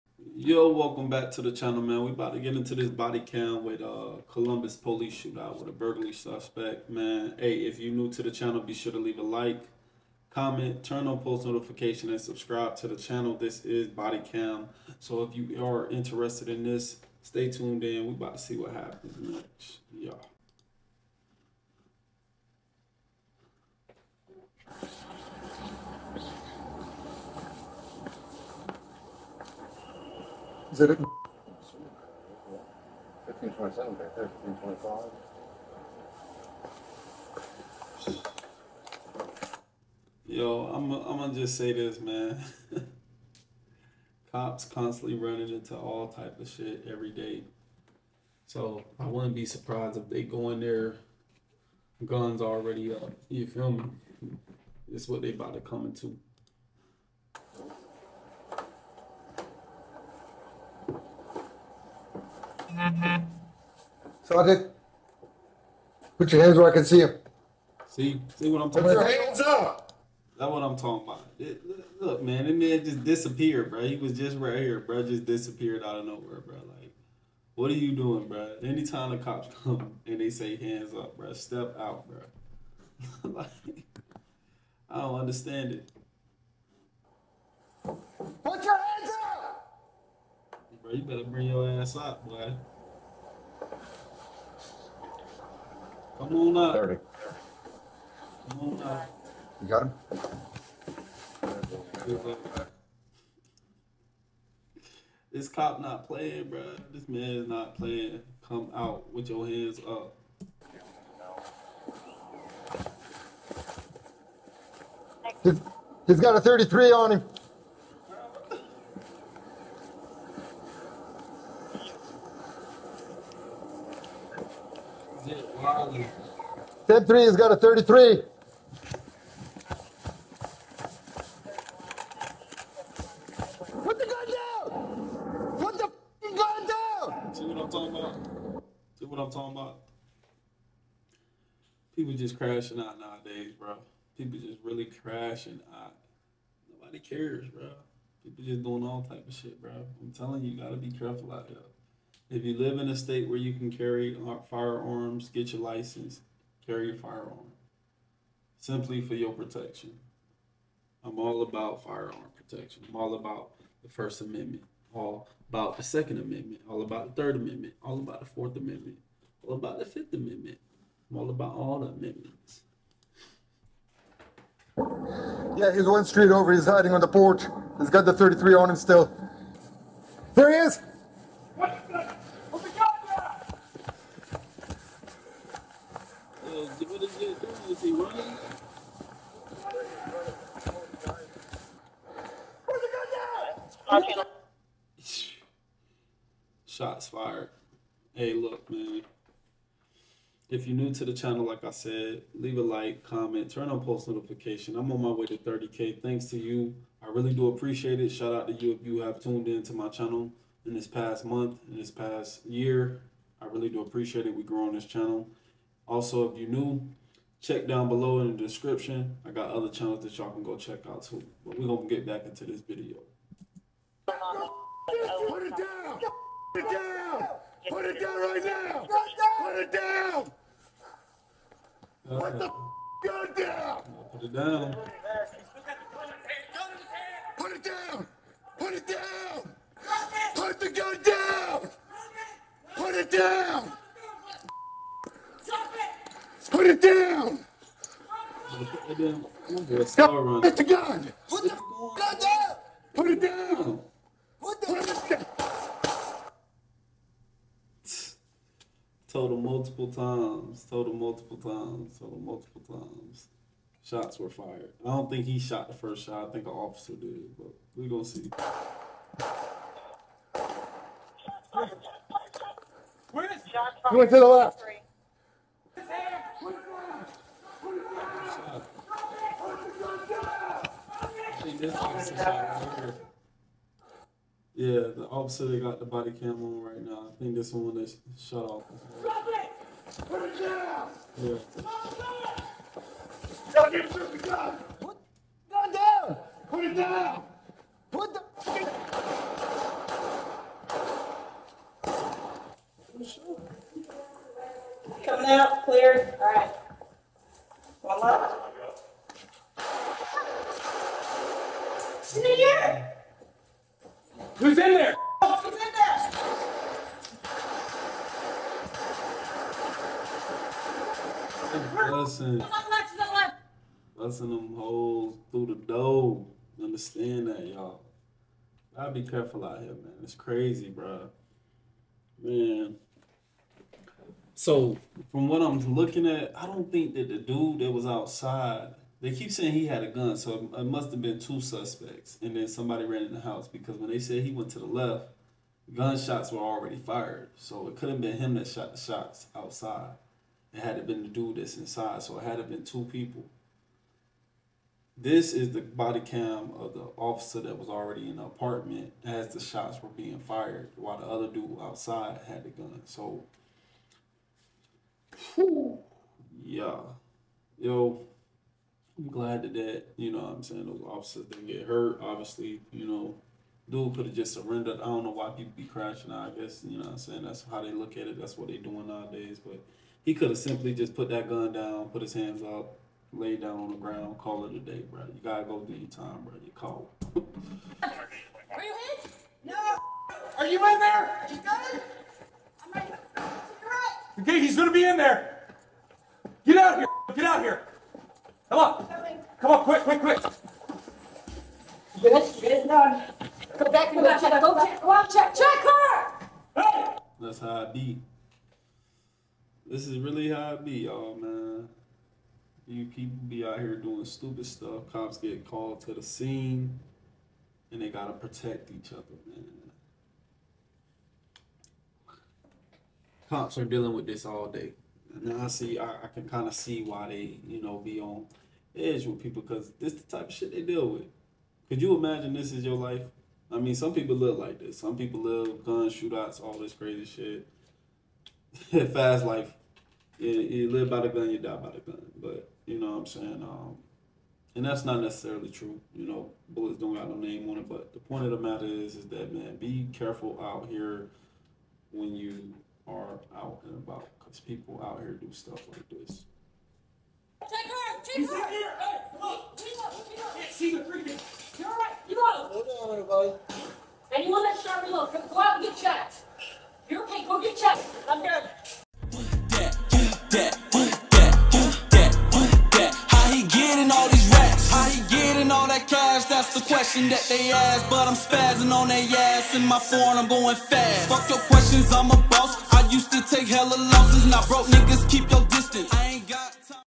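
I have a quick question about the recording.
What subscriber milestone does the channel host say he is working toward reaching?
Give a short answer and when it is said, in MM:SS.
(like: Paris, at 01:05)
30K, at 03:25.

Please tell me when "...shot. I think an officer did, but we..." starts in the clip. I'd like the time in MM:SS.
04:26.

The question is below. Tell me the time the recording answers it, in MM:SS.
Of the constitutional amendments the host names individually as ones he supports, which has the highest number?
02:49.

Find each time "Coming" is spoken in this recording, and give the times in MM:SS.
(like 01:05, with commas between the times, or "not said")
05:05, 06:38.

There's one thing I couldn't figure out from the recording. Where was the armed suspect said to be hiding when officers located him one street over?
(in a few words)
On the porch.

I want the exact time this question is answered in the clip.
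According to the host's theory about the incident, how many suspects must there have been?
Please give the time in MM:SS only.
05:41.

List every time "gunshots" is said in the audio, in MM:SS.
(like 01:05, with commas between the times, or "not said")
05:45.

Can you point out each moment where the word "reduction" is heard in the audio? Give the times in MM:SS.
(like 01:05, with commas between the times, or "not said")
not said.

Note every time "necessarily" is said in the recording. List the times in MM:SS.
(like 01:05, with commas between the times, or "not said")
07:25.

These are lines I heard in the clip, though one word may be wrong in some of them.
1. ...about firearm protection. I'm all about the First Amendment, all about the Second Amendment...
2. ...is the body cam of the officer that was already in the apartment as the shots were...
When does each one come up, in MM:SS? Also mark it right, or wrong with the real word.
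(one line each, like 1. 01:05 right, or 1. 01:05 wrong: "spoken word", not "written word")
1. 02:41 right
2. 05:55 right.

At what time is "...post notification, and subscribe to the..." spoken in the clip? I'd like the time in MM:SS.
00:11.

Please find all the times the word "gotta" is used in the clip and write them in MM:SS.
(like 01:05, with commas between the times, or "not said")
02:30, 06:25, 06:57.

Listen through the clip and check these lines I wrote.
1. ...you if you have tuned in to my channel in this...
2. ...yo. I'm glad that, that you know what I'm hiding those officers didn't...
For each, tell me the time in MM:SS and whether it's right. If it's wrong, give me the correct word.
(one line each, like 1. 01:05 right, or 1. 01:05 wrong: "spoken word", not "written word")
1. 03:28 right
2. 06:07 wrong: "saying", not "hiding".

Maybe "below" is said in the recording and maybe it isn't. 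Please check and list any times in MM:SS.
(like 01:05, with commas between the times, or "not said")
03:37, 07:44.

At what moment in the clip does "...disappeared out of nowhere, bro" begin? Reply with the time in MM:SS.
01:15.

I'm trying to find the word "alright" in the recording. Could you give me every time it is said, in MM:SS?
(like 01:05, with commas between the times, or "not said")
07:41.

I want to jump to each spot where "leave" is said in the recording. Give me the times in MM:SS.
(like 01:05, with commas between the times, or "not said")
00:08, 03:22.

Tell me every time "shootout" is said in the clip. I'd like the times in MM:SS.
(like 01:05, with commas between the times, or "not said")
00:05, 07:15.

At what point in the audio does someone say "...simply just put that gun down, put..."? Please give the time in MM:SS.
06:20.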